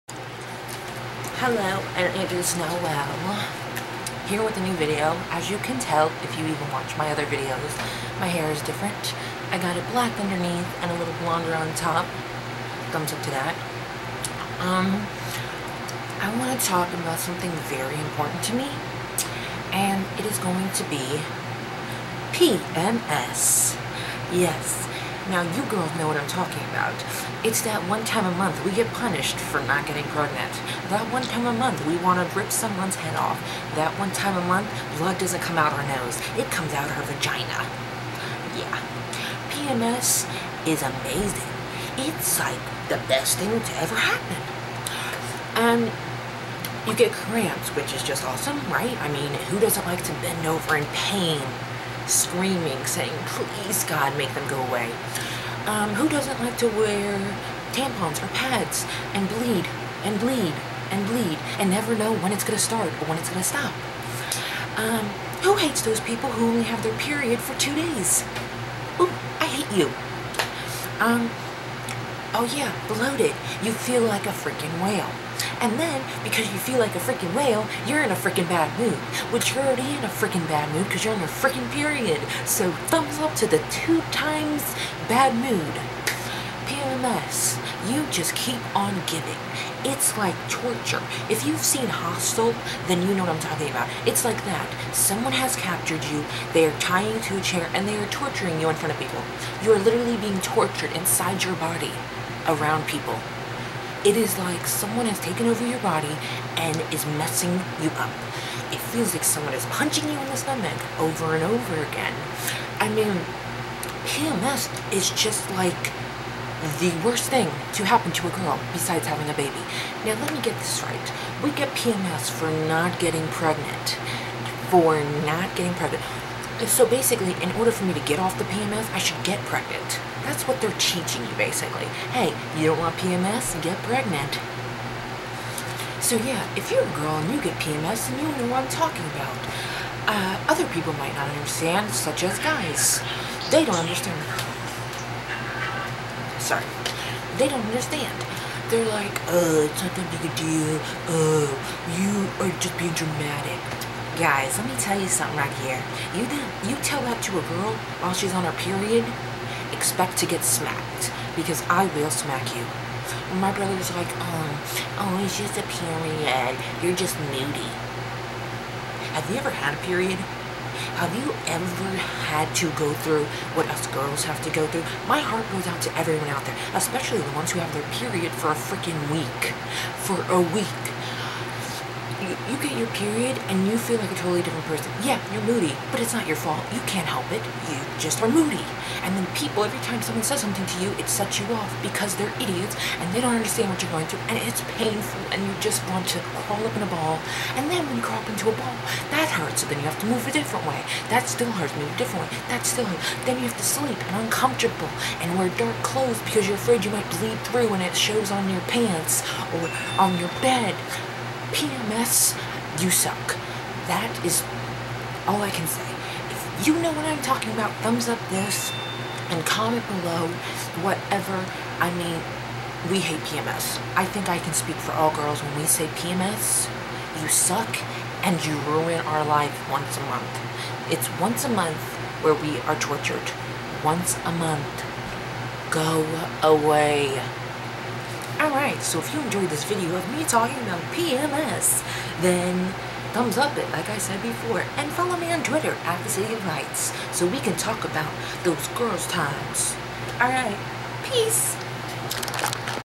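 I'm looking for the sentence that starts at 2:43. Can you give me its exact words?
My brother's like, oh, oh, it's just a period.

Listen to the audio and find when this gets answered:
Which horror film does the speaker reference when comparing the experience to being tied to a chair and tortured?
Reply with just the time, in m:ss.
1:31.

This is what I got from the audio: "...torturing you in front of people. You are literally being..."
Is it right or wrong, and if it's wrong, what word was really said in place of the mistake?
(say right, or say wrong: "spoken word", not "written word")
right.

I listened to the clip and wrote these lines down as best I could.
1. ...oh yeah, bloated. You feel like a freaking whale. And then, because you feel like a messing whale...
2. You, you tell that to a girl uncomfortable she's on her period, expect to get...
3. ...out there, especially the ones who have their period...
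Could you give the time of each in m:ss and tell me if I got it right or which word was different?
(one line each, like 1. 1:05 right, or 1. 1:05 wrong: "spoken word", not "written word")
1. 1:12 wrong: "freaking", not "messing"
2. 2:36 wrong: "while", not "uncomfortable"
3. 2:56 right.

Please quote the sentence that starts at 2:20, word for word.
Uh, other people might not understand, such as guys.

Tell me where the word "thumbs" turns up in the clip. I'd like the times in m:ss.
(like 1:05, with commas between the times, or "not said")
0:12, 1:22, 3:37, 4:03.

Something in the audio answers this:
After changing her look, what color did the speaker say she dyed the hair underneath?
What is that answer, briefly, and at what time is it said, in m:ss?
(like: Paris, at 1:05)
Black, at 0:09.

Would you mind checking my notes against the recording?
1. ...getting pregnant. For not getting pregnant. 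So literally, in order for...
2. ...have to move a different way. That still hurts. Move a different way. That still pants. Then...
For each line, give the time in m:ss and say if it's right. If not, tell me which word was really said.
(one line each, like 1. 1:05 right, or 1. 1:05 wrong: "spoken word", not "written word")
1. 2:02 wrong: "basically", not "literally"
2. 3:19 wrong: "hurts", not "pants".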